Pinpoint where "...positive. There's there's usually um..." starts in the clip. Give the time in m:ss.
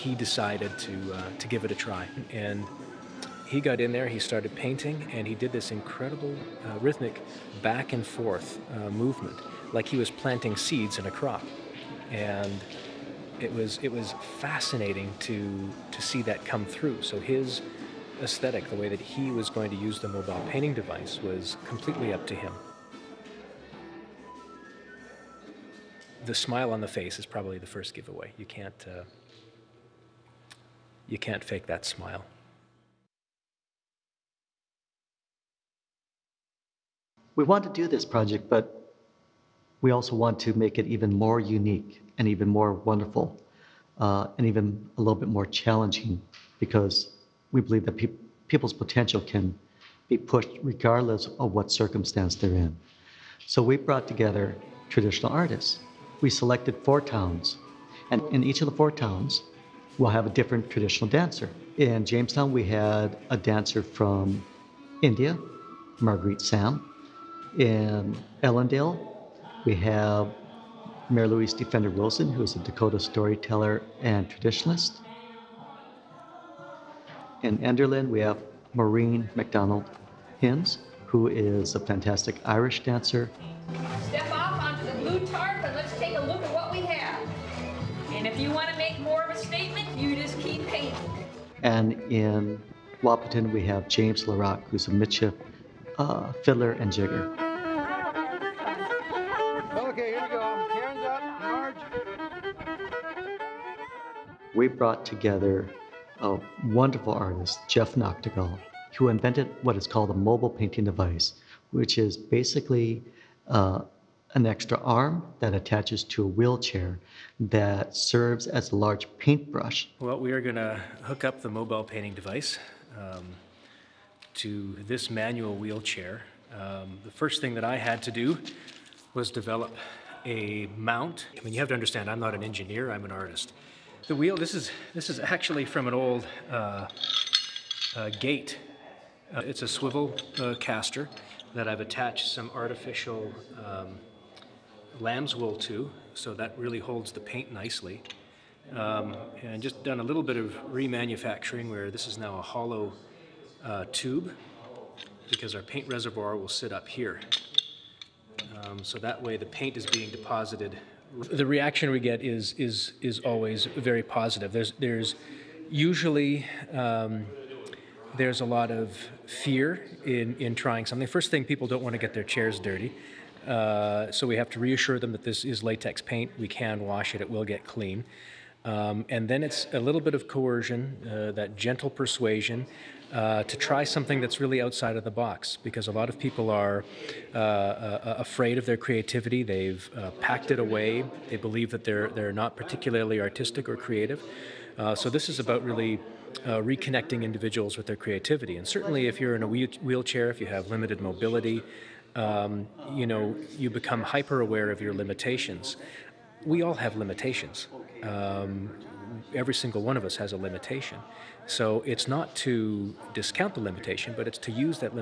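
2:44.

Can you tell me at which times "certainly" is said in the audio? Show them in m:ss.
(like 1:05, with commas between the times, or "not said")
3:18.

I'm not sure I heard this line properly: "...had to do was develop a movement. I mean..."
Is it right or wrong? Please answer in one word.
wrong.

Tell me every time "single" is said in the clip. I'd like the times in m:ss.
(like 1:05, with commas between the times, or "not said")
3:29.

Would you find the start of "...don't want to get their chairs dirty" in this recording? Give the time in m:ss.
2:51.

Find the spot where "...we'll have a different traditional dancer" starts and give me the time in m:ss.
0:59.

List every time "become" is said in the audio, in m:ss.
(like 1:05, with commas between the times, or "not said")
3:23.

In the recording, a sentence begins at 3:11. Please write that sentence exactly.
They believe that they're, they're not particularly artistic or creative.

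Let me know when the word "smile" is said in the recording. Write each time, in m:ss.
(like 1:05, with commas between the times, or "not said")
0:26, 0:31.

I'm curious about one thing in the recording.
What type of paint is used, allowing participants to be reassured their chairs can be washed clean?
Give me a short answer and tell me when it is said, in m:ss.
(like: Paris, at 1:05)
Latex paint, at 2:55.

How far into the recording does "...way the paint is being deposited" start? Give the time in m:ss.
2:39.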